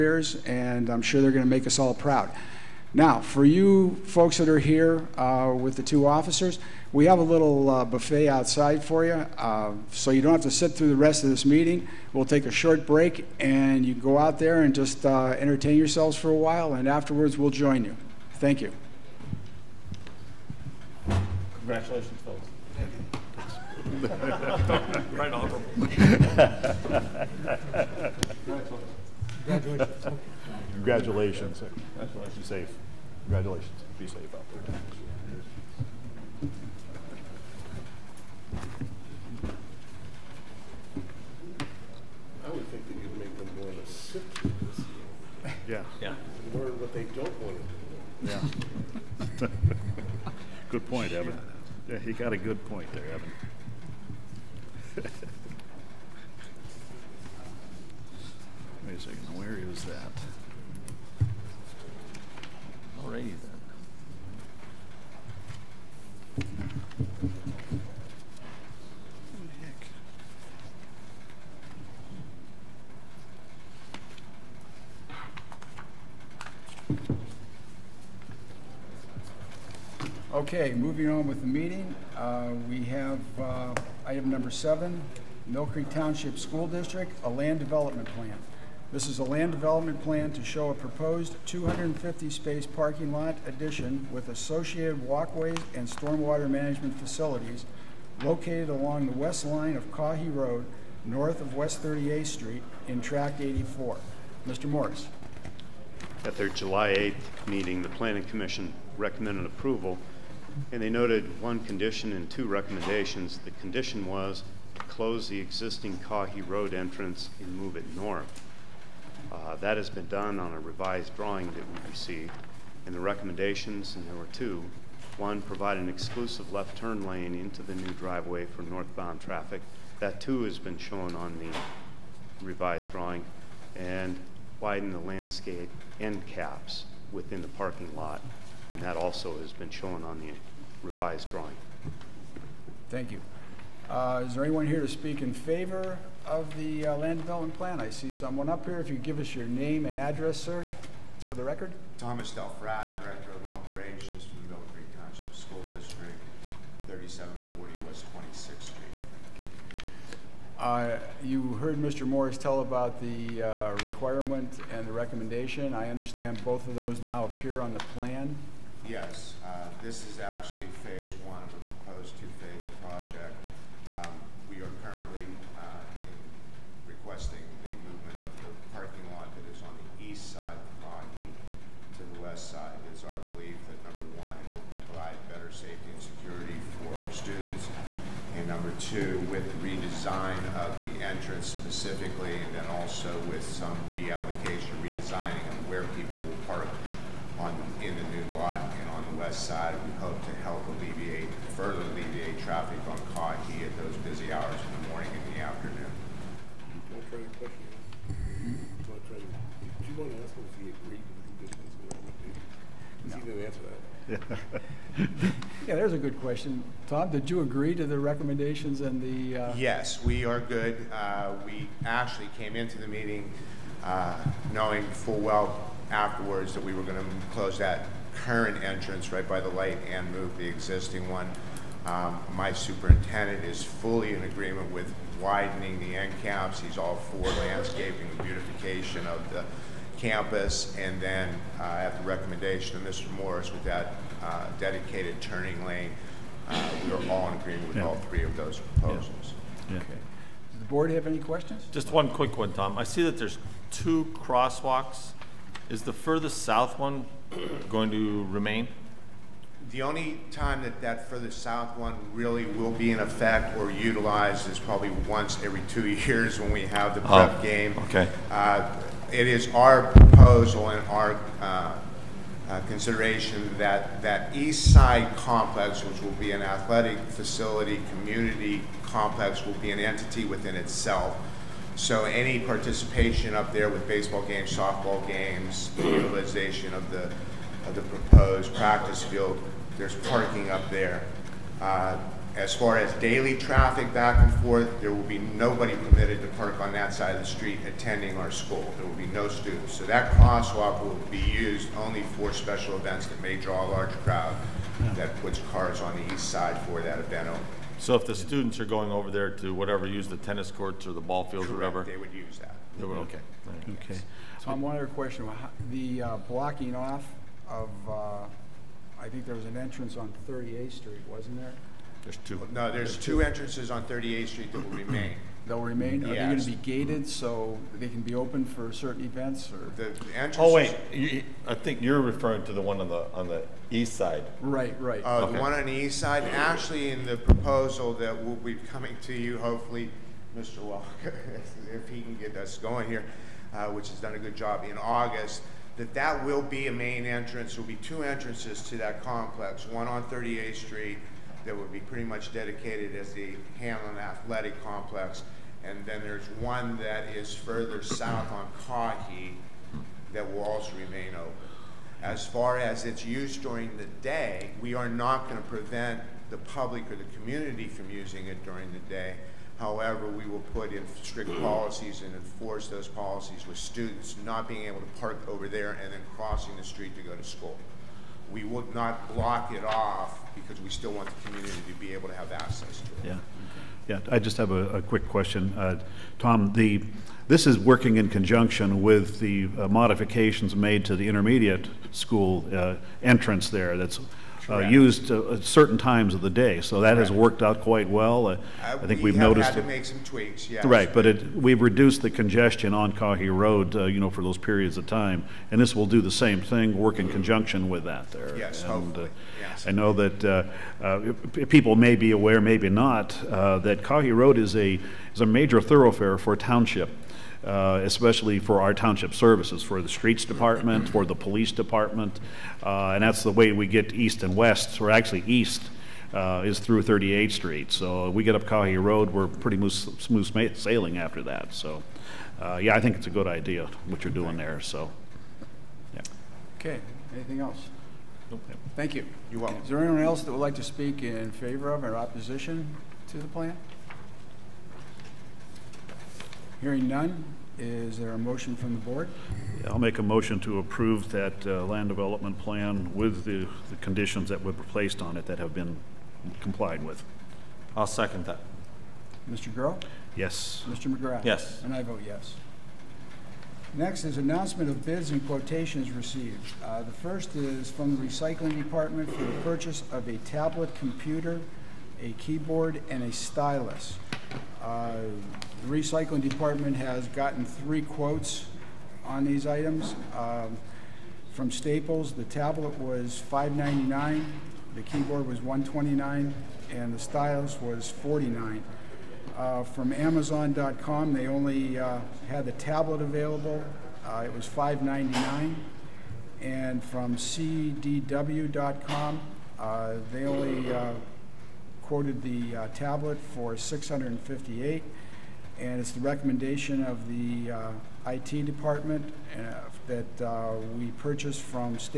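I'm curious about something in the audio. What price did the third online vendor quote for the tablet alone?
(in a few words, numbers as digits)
658.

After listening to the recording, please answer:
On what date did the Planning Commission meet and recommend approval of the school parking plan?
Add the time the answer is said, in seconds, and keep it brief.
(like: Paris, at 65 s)
July 8th, at 106 s.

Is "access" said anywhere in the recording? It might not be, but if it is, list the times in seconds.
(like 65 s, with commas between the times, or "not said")
382 s.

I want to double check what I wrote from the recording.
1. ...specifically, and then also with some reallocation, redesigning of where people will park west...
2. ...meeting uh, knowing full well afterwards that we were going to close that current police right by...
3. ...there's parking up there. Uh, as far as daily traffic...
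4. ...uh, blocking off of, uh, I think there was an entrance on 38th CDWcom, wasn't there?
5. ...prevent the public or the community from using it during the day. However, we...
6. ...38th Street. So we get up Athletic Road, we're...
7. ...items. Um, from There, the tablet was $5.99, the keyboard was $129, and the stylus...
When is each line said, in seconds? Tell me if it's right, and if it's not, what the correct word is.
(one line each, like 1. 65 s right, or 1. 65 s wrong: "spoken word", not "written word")
1. 191 s right
2. 222 s wrong: "entrance", not "police"
3. 289 s right
4. 316 s wrong: "Street", not "CDWcom"
5. 365 s right
6. 426 s wrong: "Caughey", not "Athletic"
7. 479 s wrong: "Staples", not "There".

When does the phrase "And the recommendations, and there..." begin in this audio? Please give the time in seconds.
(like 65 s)
122 s.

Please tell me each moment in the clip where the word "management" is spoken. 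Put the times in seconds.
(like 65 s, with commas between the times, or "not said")
96 s.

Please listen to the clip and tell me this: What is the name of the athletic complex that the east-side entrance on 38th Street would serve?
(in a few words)
Hanlon Athletic Complex.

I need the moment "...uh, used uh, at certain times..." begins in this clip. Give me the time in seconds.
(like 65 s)
394 s.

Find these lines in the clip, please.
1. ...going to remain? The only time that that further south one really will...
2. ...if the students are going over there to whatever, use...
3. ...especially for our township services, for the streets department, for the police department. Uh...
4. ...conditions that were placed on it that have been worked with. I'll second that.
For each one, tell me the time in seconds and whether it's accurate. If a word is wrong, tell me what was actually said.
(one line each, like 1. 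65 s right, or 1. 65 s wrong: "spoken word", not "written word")
1. 257 s right
2. 307 s right
3. 417 s right
4. 453 s wrong: "complied", not "worked".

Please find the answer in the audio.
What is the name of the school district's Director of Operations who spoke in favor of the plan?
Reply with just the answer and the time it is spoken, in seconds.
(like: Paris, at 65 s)
Thomas Delfrat, at 151 s.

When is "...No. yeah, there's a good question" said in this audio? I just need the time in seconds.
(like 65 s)
214 s.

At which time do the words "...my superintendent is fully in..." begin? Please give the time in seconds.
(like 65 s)
232 s.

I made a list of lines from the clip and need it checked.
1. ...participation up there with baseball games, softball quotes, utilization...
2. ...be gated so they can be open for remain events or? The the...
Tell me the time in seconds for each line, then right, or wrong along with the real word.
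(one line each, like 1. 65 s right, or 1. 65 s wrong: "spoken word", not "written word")
1. 282 s wrong: "games", not "quotes"
2. 326 s wrong: "certain", not "remain".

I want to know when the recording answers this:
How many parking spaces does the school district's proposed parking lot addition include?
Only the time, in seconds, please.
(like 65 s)
91 s.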